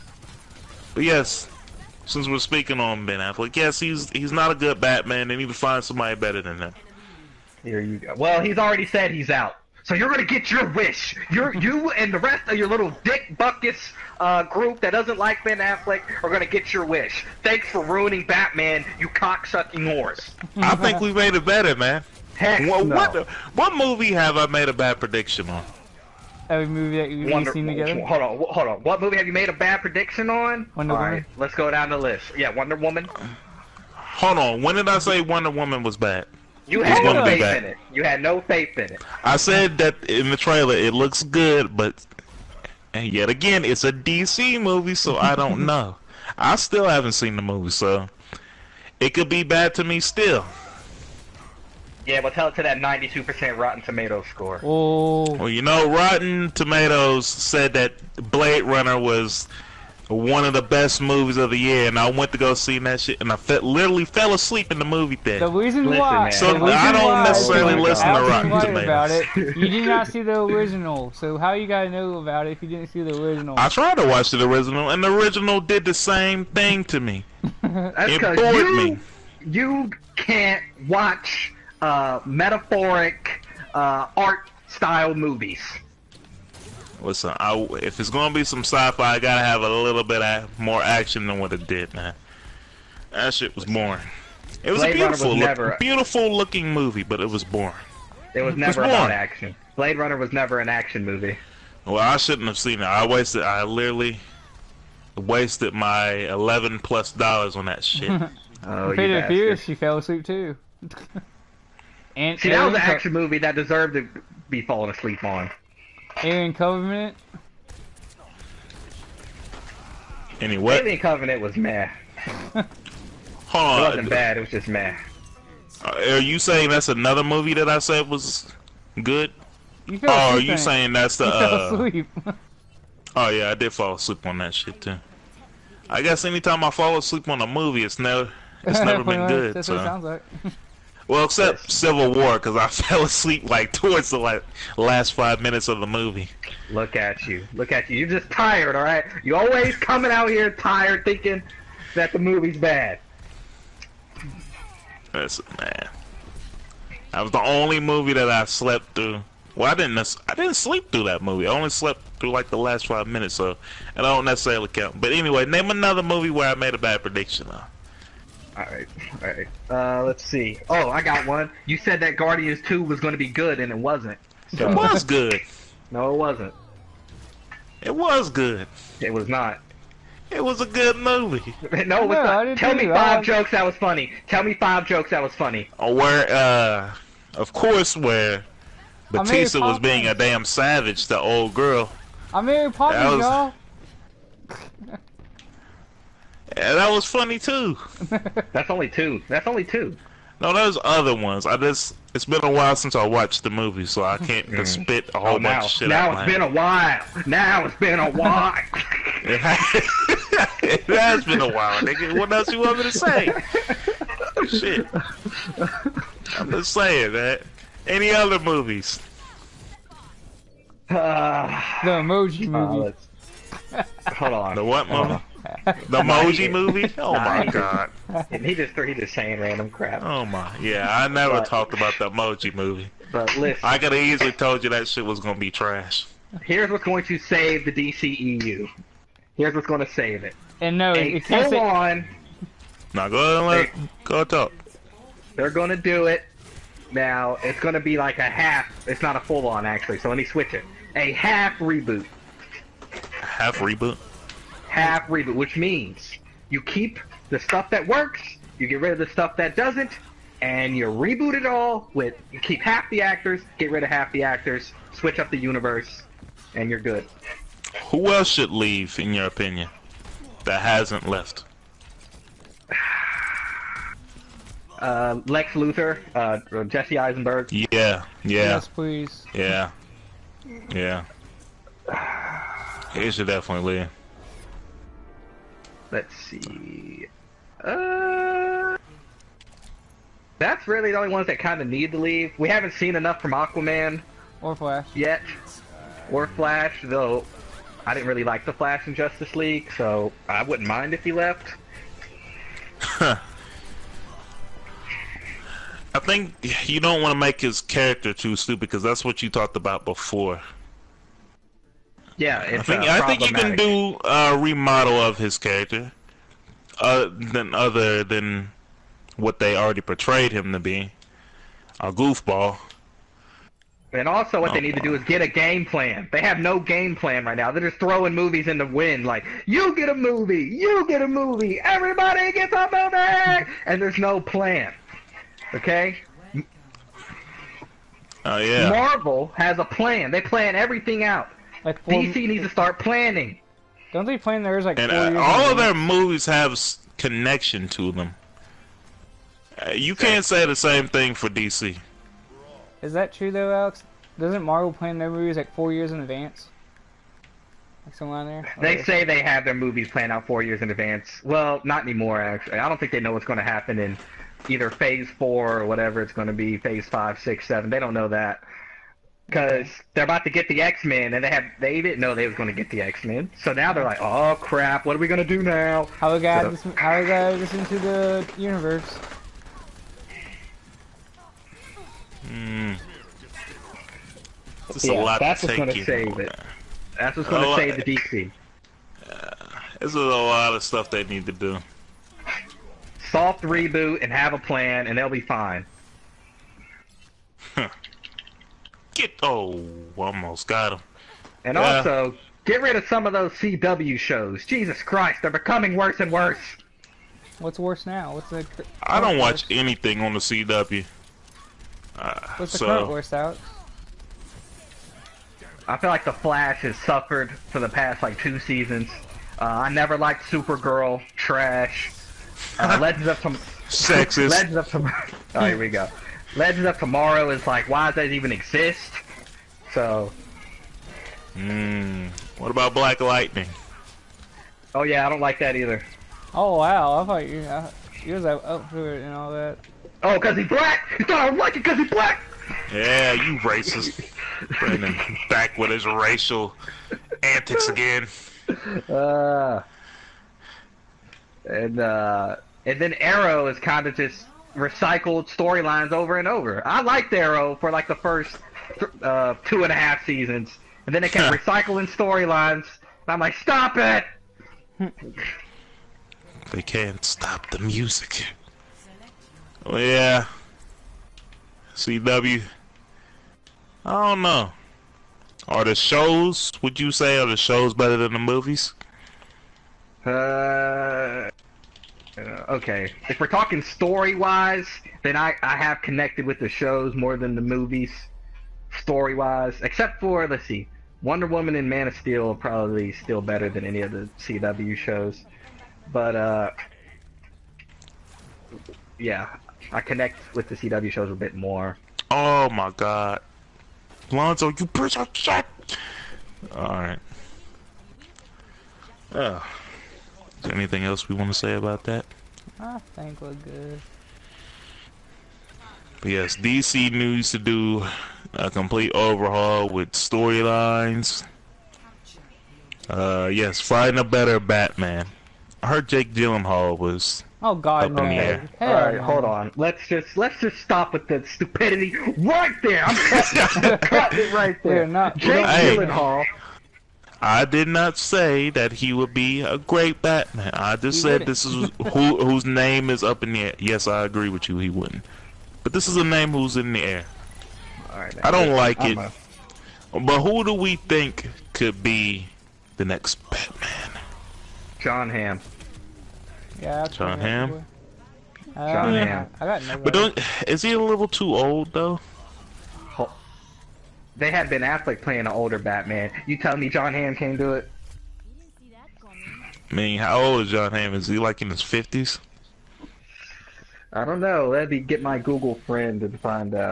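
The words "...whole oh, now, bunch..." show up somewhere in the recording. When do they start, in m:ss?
3:25.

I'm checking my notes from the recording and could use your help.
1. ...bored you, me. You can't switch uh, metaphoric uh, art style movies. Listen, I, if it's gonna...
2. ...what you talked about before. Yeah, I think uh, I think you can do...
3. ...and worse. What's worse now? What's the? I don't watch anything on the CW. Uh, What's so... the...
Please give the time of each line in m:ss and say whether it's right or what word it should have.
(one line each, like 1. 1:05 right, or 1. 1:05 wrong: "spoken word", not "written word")
1. 1:18 wrong: "watch", not "switch"
2. 5:09 right
3. 6:46 right.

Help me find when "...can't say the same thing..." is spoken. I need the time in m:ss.
5:49.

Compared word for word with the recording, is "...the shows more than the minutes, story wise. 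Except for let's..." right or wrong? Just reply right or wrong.
wrong.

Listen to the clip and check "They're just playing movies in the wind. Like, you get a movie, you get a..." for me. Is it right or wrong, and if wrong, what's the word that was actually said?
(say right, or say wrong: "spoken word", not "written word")
wrong: "throwing", not "playing".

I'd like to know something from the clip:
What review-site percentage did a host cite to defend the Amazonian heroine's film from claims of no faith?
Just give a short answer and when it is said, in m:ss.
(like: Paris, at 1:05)
92%, at 0:52.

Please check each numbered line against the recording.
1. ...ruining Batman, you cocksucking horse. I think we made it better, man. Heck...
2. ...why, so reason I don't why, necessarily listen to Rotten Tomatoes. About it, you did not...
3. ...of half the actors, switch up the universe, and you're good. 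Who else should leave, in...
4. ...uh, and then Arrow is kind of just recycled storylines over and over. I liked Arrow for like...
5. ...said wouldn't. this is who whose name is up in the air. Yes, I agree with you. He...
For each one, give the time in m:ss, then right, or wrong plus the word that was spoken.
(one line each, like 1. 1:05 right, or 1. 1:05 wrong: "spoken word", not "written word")
1. 0:17 right
2. 1:05 right
3. 4:23 right
4. 7:31 right
5. 9:01 right.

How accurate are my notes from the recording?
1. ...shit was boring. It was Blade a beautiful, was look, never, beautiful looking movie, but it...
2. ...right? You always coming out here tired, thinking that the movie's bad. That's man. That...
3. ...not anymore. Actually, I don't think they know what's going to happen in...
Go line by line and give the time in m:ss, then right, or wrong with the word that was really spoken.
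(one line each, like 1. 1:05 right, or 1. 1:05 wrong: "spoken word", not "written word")
1. 1:33 right
2. 2:28 right
3. 6:01 right.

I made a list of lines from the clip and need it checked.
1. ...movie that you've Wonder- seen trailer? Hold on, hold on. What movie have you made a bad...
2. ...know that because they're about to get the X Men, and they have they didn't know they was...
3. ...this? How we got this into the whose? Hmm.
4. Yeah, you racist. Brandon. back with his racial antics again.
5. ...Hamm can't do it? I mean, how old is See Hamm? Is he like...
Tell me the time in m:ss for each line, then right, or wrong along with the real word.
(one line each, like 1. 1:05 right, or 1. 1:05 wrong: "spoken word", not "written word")
1. 0:26 wrong: "together", not "trailer"
2. 6:07 right
3. 6:16 wrong: "universe", not "whose"
4. 7:22 right
5. 9:26 wrong: "John", not "See".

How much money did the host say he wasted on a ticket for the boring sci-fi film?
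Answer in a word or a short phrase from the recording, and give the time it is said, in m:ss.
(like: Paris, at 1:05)
eleven plus dollars, at 1:46.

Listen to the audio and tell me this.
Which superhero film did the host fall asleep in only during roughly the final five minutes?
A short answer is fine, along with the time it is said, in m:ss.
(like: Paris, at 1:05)
Civil War, at 2:21.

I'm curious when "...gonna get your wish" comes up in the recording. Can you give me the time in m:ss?
0:10.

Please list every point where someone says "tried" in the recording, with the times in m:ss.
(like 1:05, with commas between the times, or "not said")
1:13.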